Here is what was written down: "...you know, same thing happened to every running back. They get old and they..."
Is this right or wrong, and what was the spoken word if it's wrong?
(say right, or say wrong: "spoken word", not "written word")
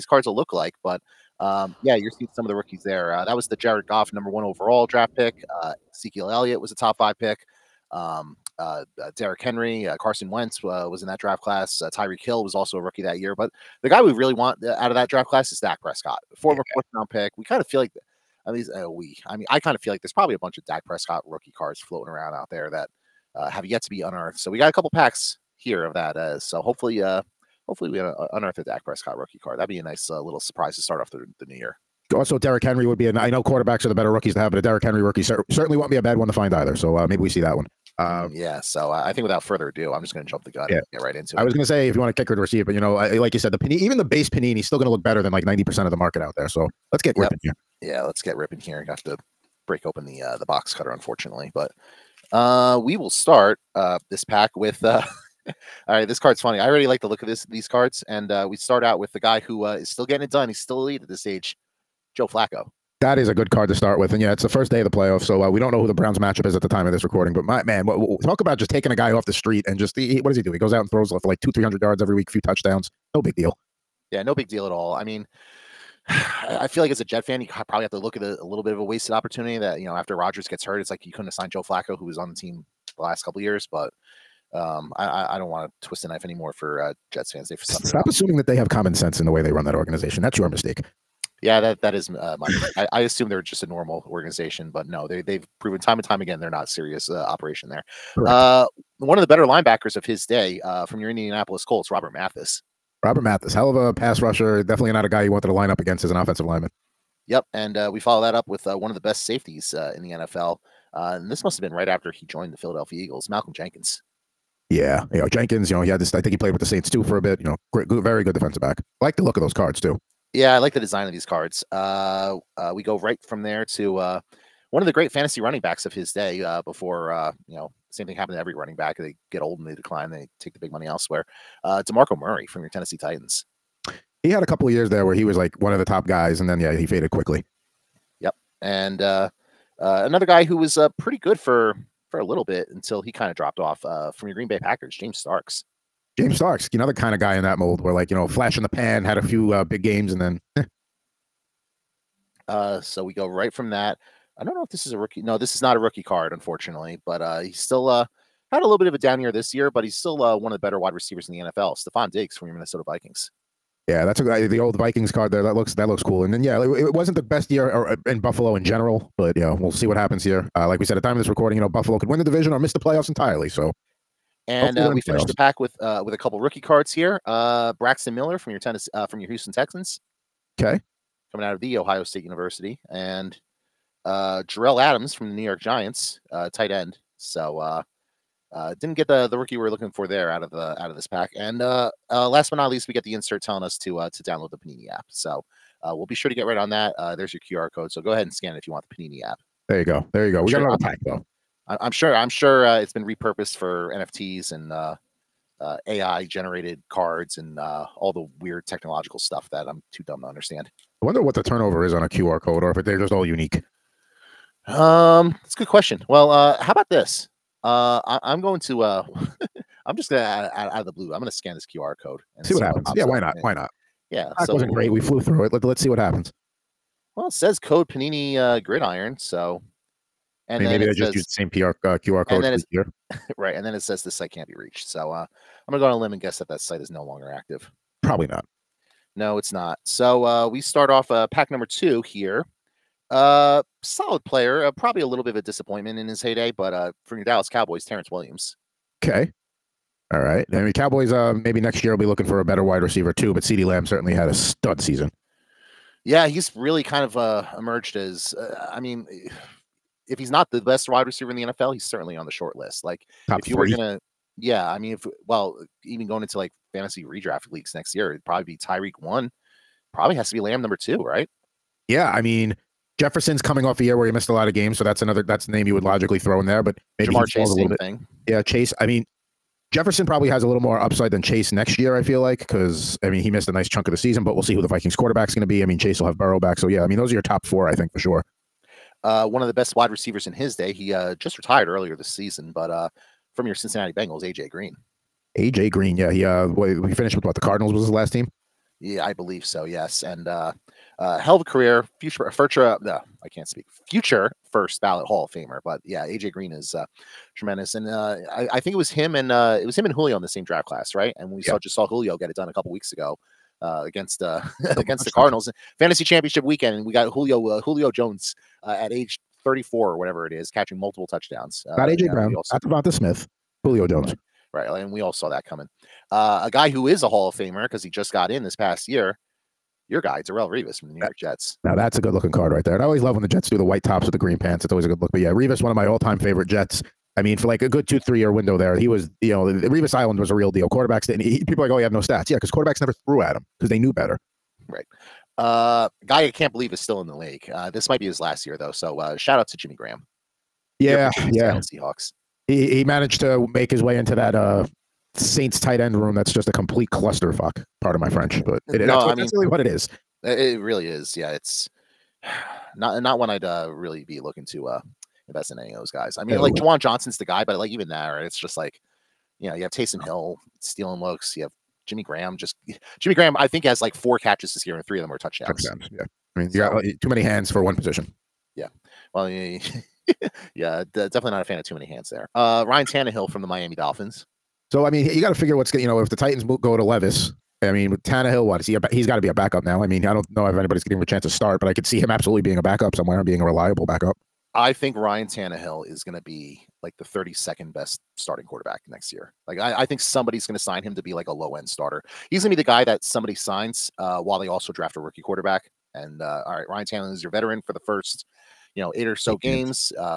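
right.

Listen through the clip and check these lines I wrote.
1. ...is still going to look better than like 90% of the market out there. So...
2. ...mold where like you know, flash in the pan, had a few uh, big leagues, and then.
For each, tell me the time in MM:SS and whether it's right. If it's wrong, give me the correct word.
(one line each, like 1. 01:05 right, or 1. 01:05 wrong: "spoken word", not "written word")
1. 00:44 right
2. 02:27 wrong: "games", not "leagues".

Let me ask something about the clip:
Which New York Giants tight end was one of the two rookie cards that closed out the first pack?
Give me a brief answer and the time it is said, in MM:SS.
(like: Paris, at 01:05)
Jerell Adams, at 03:04.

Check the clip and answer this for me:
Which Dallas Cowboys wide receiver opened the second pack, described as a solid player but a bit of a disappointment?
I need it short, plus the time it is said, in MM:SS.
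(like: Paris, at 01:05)
Terrence Williams, at 04:07.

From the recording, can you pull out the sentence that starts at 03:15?
So uh, we'll be sure to get right on that.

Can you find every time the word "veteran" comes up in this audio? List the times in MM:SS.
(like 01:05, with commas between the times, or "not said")
06:47.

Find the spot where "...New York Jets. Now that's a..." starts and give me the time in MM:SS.
05:30.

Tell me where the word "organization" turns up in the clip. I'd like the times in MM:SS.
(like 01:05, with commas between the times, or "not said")
01:29, 01:34.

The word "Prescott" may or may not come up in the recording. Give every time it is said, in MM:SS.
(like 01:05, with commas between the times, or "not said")
00:15, 00:20, 00:28.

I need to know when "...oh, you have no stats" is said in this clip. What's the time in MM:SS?
05:41.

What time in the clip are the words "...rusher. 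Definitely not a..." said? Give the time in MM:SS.
01:44.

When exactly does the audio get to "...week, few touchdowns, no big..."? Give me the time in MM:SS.
01:12.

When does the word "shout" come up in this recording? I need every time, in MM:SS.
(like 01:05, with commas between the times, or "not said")
05:49.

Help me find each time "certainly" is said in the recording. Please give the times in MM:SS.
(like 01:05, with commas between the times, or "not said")
00:35, 04:13, 04:21.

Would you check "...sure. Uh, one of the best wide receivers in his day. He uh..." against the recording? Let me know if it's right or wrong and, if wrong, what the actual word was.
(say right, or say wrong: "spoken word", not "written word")
right.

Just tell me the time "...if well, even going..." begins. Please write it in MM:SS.
04:24.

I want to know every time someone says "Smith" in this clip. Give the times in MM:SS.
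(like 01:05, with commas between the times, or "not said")
05:22.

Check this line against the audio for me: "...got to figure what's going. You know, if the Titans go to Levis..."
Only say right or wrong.
right.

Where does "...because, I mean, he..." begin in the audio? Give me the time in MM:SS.
04:42.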